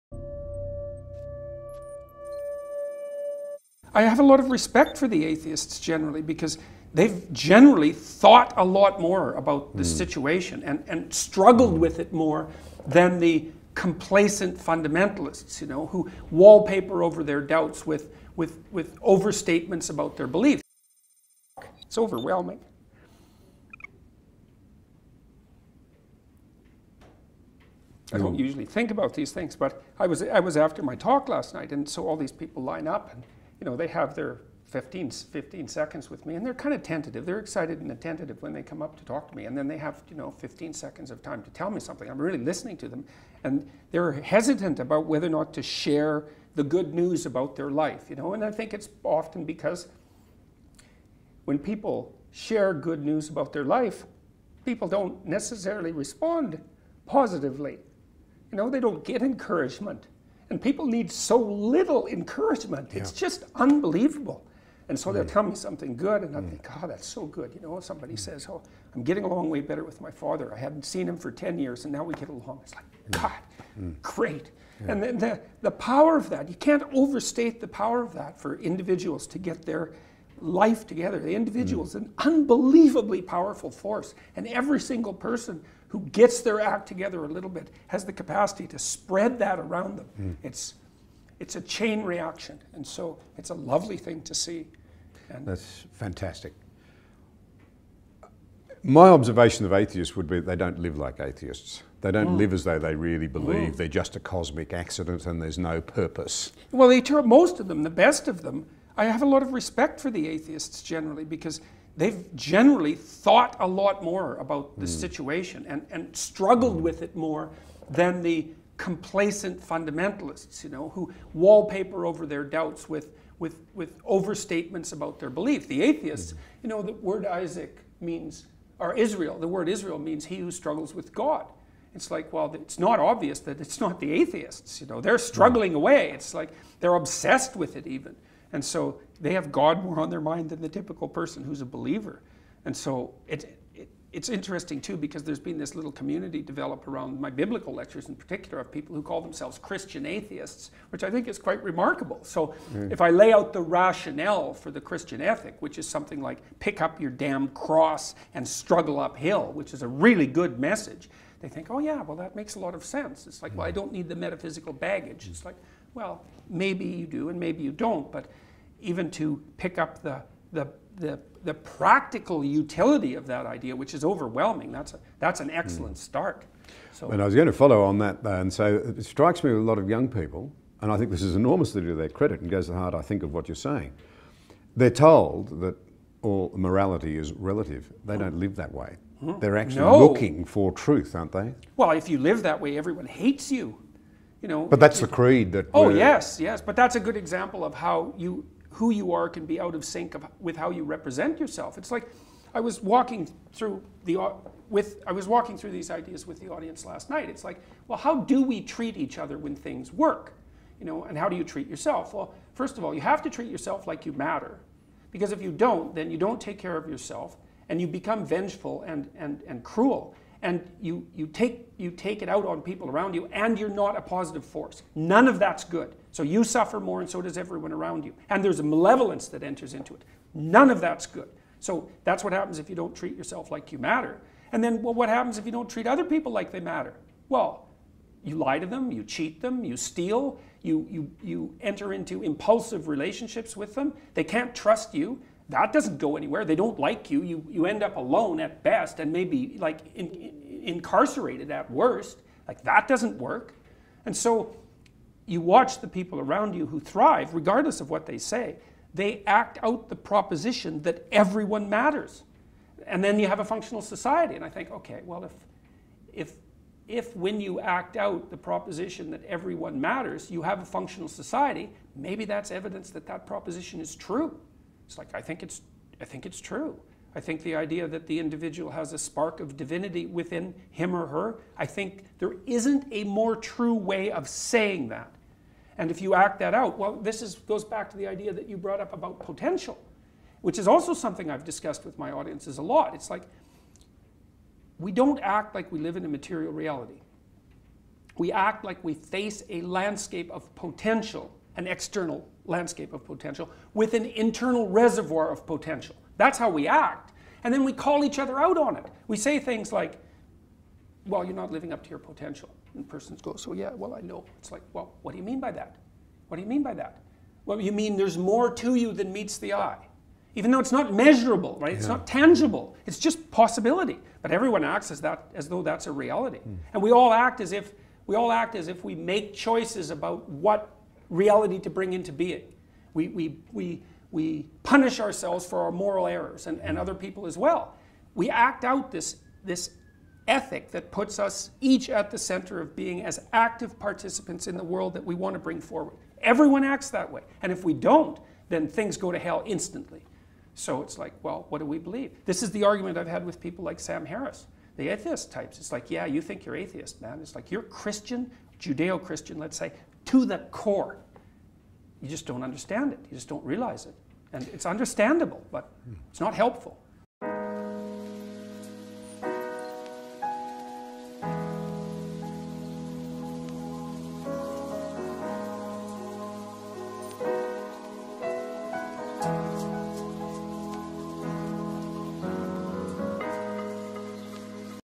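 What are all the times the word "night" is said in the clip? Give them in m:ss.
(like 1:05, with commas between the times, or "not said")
0:31, 3:27.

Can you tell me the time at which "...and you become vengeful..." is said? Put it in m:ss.
3:37.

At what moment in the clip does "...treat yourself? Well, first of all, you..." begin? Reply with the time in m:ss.
3:31.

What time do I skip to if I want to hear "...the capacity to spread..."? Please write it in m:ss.
1:28.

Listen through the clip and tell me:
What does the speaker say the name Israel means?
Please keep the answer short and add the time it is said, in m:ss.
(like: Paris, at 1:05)
he who struggles with God, at 2:10.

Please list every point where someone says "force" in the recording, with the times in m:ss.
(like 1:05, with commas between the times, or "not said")
1:23, 3:44.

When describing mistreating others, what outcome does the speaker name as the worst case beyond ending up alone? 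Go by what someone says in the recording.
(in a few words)
incarcerated.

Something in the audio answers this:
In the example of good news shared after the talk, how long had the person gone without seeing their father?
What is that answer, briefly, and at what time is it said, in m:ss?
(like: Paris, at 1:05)
10 years, at 1:11.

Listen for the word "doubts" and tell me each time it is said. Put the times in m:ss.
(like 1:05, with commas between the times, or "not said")
0:17, 2:02.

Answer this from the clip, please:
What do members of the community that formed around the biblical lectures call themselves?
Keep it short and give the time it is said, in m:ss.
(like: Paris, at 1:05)
Christian atheists, at 2:29.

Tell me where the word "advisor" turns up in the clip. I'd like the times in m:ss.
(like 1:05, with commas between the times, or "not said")
not said.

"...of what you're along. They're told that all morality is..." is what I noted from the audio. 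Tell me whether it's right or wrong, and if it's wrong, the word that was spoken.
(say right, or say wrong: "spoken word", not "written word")
wrong: "saying", not "along".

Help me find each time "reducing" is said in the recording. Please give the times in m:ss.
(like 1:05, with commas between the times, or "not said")
not said.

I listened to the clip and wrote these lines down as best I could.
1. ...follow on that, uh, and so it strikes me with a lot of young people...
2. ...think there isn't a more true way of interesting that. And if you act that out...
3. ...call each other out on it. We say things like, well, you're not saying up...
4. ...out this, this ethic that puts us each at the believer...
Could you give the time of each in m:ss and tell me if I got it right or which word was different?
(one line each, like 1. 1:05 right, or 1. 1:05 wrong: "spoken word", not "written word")
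1. 2:57 right
2. 4:41 wrong: "saying", not "interesting"
3. 5:07 wrong: "living", not "saying"
4. 5:38 wrong: "center", not "believer".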